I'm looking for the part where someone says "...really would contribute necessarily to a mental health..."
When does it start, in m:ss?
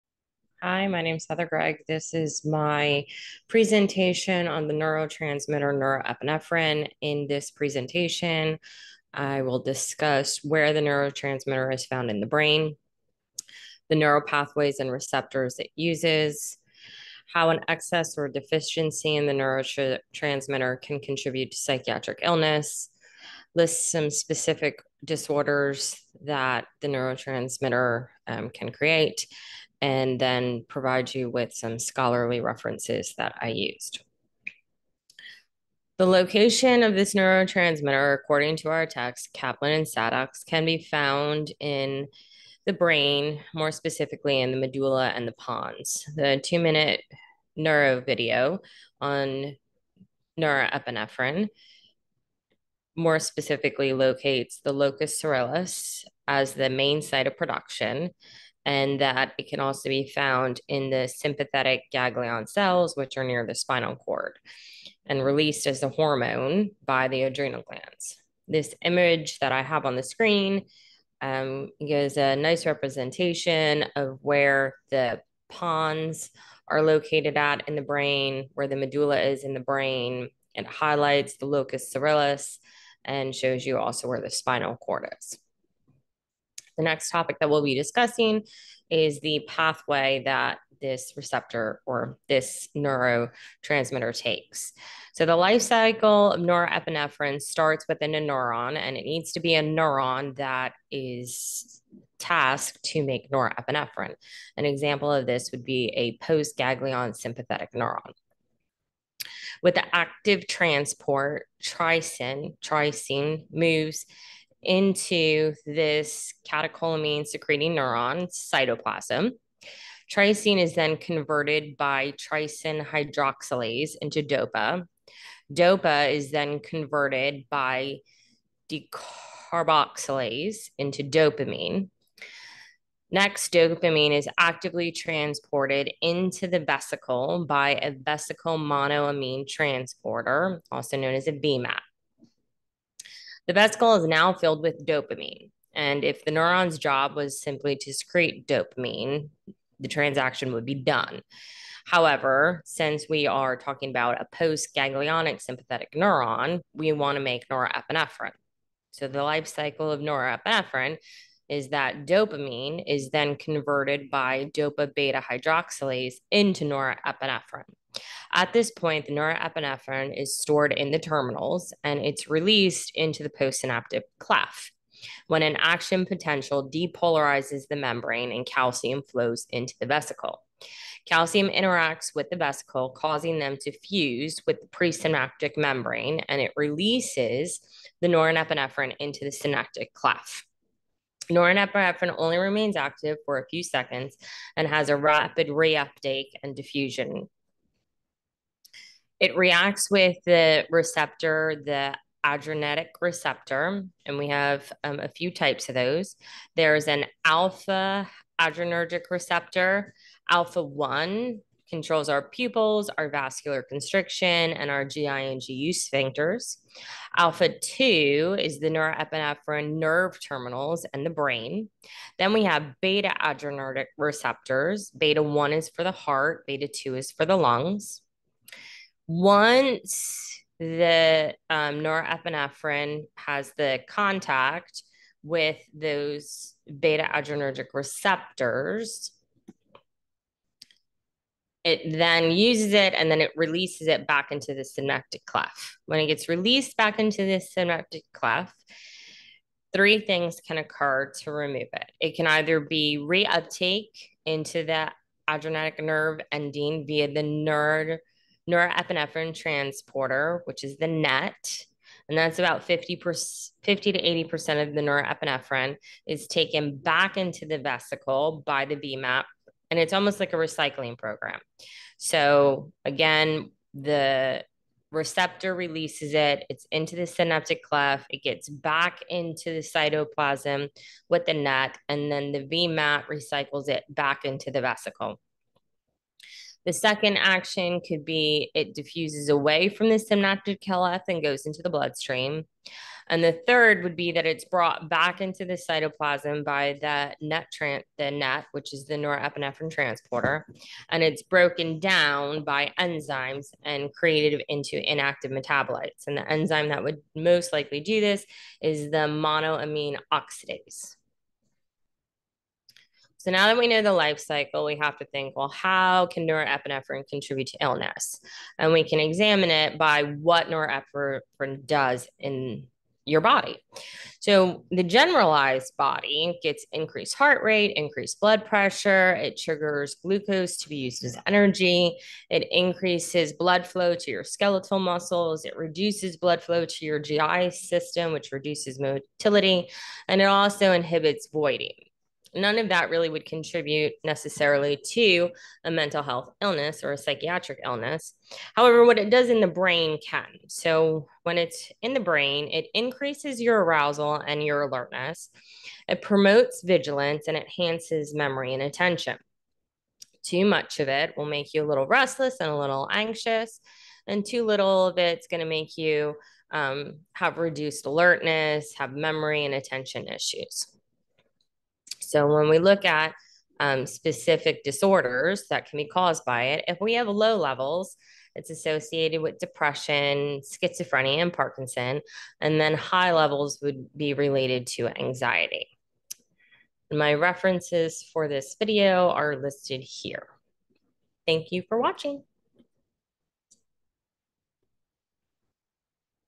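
5:42.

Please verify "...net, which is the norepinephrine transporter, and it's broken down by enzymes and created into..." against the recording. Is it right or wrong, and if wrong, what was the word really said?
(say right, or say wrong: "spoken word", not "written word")
right.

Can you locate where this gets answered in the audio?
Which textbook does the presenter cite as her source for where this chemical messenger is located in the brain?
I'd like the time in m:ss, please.
0:39.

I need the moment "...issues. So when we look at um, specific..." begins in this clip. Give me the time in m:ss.
6:10.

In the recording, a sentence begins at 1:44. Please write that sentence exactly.
An example of this would be a post-ganglion sympathetic neuron.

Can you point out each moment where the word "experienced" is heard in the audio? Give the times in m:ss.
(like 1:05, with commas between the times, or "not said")
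not said.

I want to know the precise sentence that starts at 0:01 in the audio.
This is my presentation on the neurotransmitter neuroepinephrine.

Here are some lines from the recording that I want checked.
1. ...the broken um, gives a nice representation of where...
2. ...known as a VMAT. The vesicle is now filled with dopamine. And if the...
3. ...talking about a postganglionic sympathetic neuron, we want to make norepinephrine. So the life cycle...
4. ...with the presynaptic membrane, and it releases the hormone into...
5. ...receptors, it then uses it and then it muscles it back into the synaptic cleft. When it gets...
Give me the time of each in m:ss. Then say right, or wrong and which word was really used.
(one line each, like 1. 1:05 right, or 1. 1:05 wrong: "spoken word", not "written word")
1. 1:09 wrong: "screen", not "broken"
2. 2:20 right
3. 2:33 right
4. 3:04 wrong: "norepinephrine", not "hormone"
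5. 3:57 wrong: "releases", not "muscles".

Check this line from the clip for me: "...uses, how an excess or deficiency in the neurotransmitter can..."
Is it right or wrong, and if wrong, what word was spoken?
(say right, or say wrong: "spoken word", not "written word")
right.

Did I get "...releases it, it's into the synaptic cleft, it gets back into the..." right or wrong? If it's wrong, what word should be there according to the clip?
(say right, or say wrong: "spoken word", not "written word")
right.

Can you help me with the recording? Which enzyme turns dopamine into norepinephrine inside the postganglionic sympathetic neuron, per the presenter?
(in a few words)
dopa beta hydroxylase.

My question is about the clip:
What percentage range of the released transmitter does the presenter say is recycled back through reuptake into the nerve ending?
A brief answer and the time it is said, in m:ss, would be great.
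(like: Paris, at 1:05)
50 to 80%, at 4:23.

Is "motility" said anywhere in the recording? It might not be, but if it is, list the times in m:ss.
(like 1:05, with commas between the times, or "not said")
5:38.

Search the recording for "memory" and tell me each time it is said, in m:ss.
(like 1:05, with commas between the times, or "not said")
5:58, 6:08.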